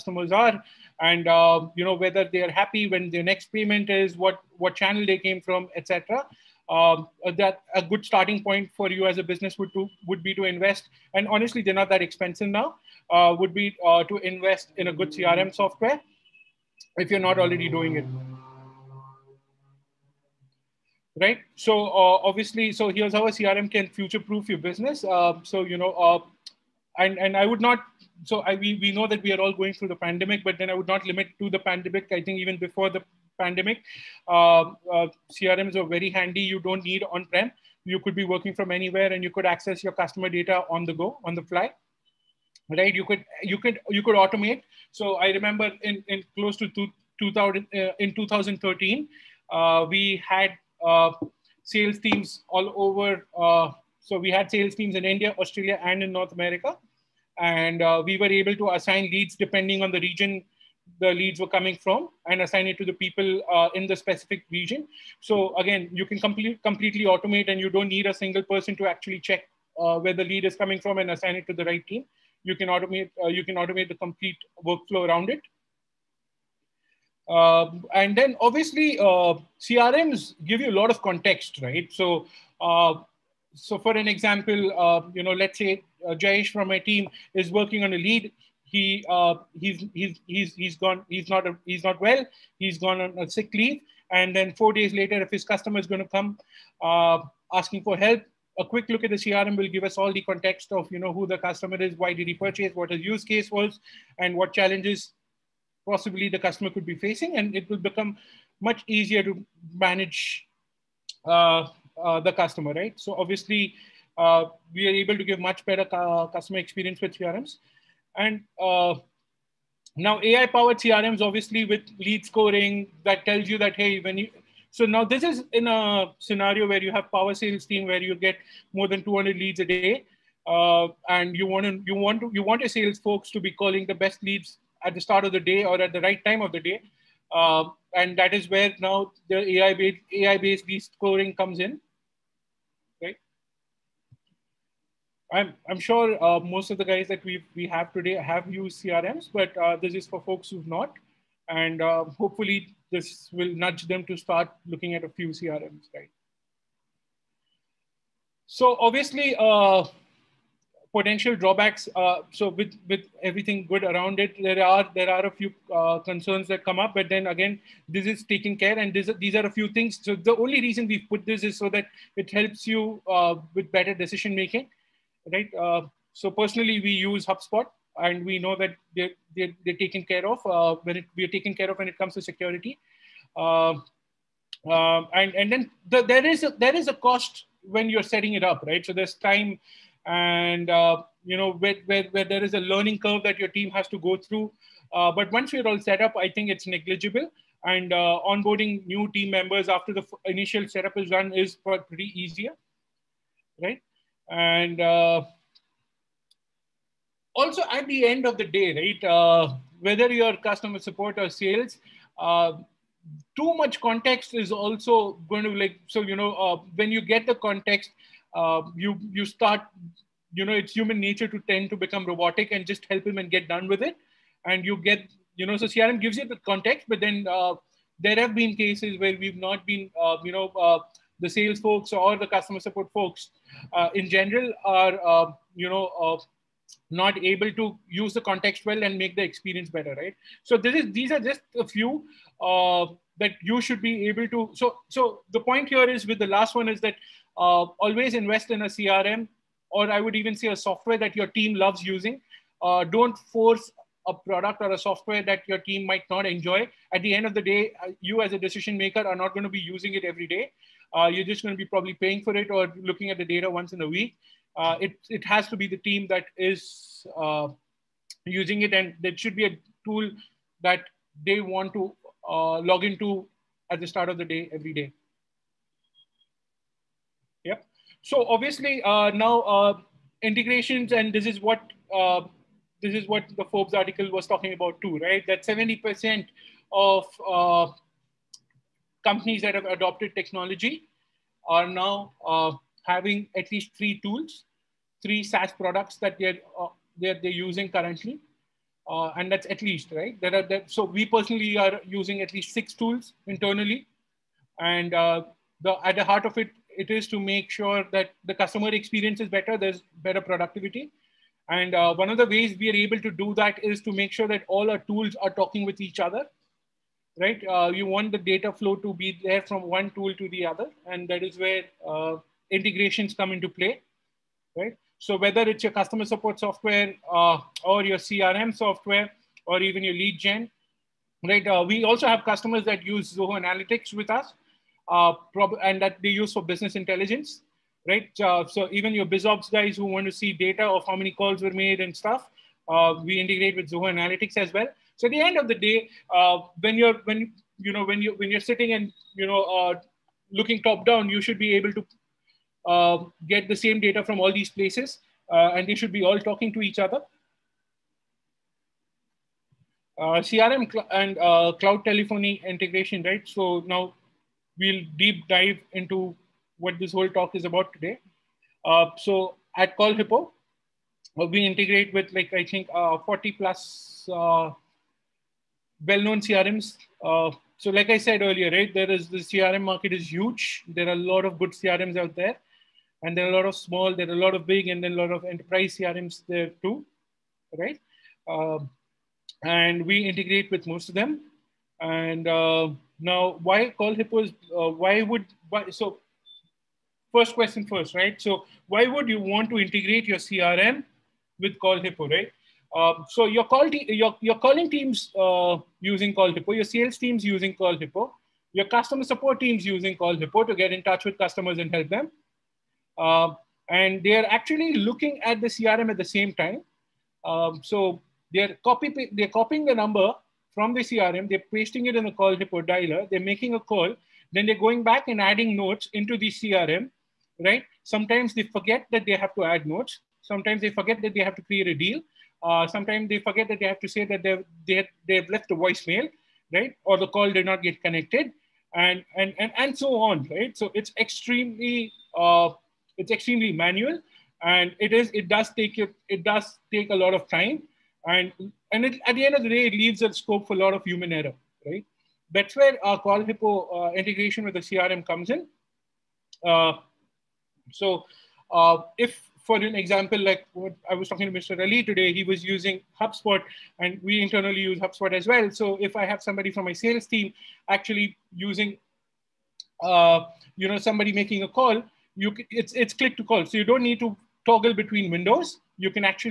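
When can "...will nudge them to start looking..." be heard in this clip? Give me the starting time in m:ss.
2:33.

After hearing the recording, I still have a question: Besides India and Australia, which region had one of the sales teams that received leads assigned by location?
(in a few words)
North America.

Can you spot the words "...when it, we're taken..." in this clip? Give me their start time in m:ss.
3:00.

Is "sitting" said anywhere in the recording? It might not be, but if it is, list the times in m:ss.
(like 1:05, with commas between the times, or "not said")
5:48.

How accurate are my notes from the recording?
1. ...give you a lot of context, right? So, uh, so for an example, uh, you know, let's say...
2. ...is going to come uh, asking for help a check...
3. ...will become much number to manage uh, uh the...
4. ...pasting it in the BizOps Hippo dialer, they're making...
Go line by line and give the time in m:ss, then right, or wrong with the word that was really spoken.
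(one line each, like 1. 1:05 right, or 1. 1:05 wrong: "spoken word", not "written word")
1. 1:20 right
2. 1:35 wrong: "quick", not "check"
3. 1:47 wrong: "easier", not "number"
4. 7:01 wrong: "Call", not "BizOps".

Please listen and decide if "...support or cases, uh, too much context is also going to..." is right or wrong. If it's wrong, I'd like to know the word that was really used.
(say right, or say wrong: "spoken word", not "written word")
wrong: "sales", not "cases".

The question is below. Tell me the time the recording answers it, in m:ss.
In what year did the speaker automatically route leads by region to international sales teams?
0:48.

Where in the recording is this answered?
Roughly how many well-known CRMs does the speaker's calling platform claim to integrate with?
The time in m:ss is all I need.
6:12.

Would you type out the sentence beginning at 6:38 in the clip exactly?
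So why would you want to integrate your CRM with call hippo, right?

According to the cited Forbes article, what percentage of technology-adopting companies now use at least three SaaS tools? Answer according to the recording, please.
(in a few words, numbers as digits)
70%.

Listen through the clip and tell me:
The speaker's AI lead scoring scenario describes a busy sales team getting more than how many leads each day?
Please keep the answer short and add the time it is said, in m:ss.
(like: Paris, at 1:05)
200, at 2:09.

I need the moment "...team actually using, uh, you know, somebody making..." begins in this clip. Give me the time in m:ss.
7:47.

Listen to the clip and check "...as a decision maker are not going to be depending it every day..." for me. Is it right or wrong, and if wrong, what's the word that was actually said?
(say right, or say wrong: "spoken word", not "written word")
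wrong: "using", not "depending".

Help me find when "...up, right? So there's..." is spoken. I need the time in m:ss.
3:08.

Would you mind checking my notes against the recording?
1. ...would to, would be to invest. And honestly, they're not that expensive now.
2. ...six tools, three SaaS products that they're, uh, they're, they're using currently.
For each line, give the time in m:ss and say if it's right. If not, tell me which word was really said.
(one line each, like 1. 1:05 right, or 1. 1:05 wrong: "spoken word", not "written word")
1. 0:09 right
2. 4:53 wrong: "three", not "six".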